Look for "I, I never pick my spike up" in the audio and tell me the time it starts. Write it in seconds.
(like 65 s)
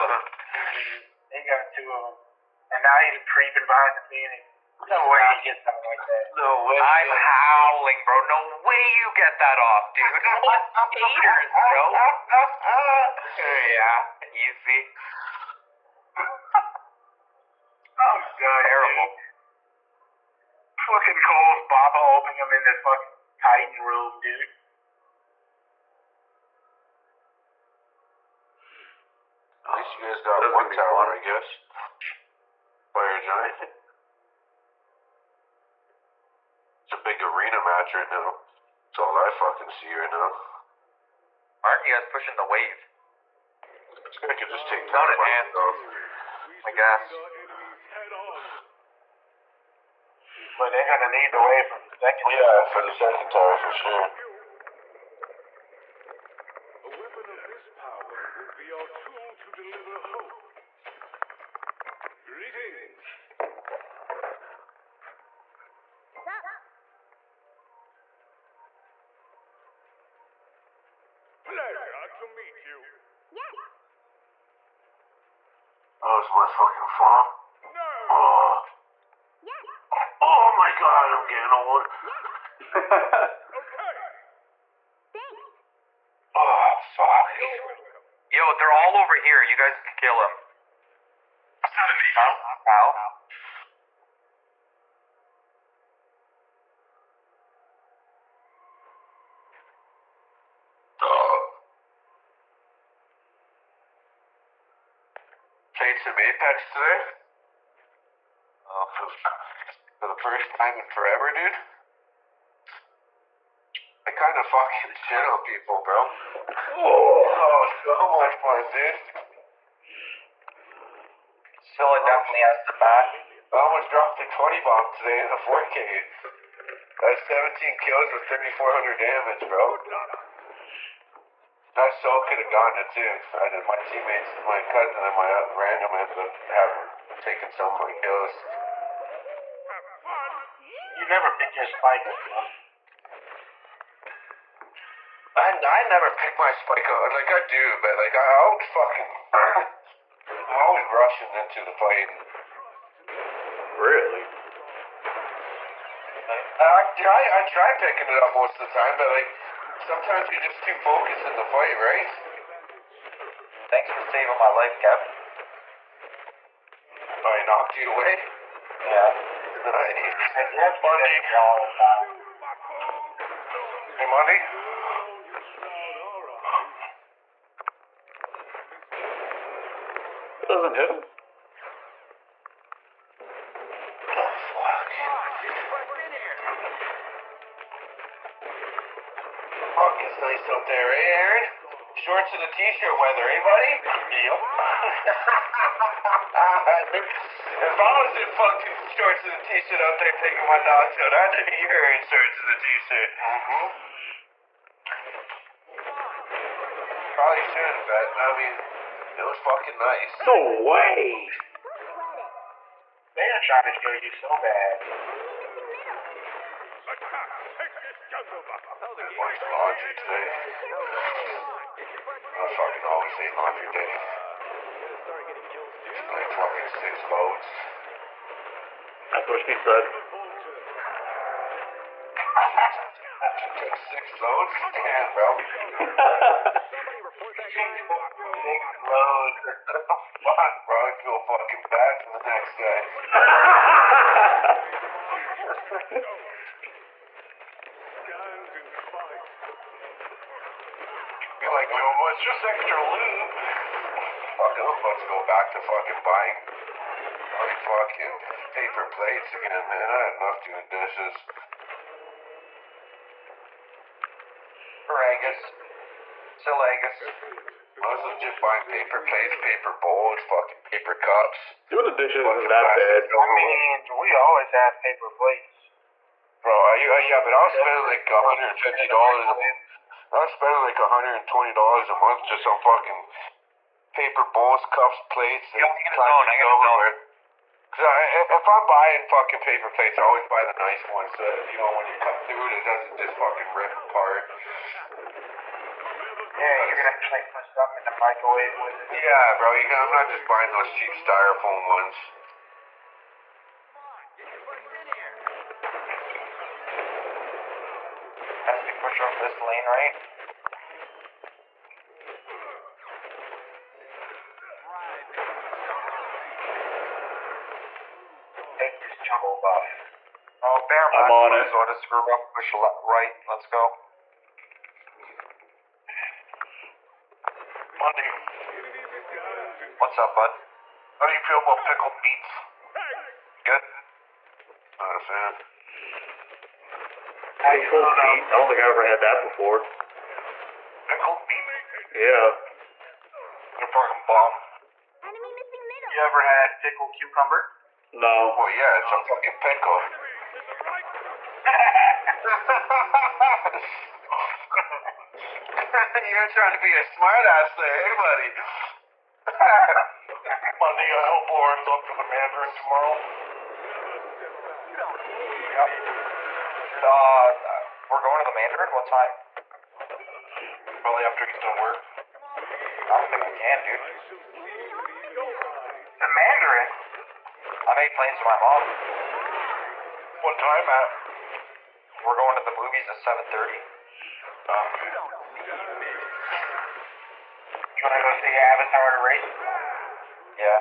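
145 s.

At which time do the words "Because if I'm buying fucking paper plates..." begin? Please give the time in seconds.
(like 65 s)
287 s.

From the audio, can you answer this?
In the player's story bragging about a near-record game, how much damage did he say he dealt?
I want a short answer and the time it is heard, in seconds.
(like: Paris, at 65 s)
3,400, at 128 s.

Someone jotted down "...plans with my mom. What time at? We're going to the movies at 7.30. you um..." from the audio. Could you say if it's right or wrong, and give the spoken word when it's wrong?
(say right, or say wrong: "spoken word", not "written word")
right.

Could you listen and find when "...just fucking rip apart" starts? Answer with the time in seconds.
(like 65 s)
292 s.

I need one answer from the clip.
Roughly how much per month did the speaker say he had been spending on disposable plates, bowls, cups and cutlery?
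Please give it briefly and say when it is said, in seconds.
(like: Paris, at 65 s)
$120, at 280 s.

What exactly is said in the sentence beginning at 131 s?
And I still could have gone to too.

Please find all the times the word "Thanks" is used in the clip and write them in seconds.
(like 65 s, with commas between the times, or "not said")
85 s, 163 s.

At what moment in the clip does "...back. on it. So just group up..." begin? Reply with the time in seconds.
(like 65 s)
320 s.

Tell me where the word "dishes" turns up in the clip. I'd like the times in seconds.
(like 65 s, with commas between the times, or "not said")
260 s, 271 s.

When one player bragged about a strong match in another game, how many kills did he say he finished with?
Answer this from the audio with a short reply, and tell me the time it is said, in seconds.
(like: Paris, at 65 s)
17, at 127 s.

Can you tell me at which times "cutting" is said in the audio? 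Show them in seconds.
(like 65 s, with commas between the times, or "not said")
not said.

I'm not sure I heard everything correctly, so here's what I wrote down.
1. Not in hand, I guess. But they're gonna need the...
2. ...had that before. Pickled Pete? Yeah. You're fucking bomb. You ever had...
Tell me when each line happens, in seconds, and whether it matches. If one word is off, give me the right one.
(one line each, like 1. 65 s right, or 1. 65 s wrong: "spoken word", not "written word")
1. 44 s right
2. 338 s right.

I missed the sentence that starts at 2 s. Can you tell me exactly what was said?
Um, and now he's creeping behind the painting.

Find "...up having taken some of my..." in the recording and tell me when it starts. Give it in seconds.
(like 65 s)
136 s.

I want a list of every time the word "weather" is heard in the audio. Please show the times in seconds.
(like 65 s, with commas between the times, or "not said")
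192 s.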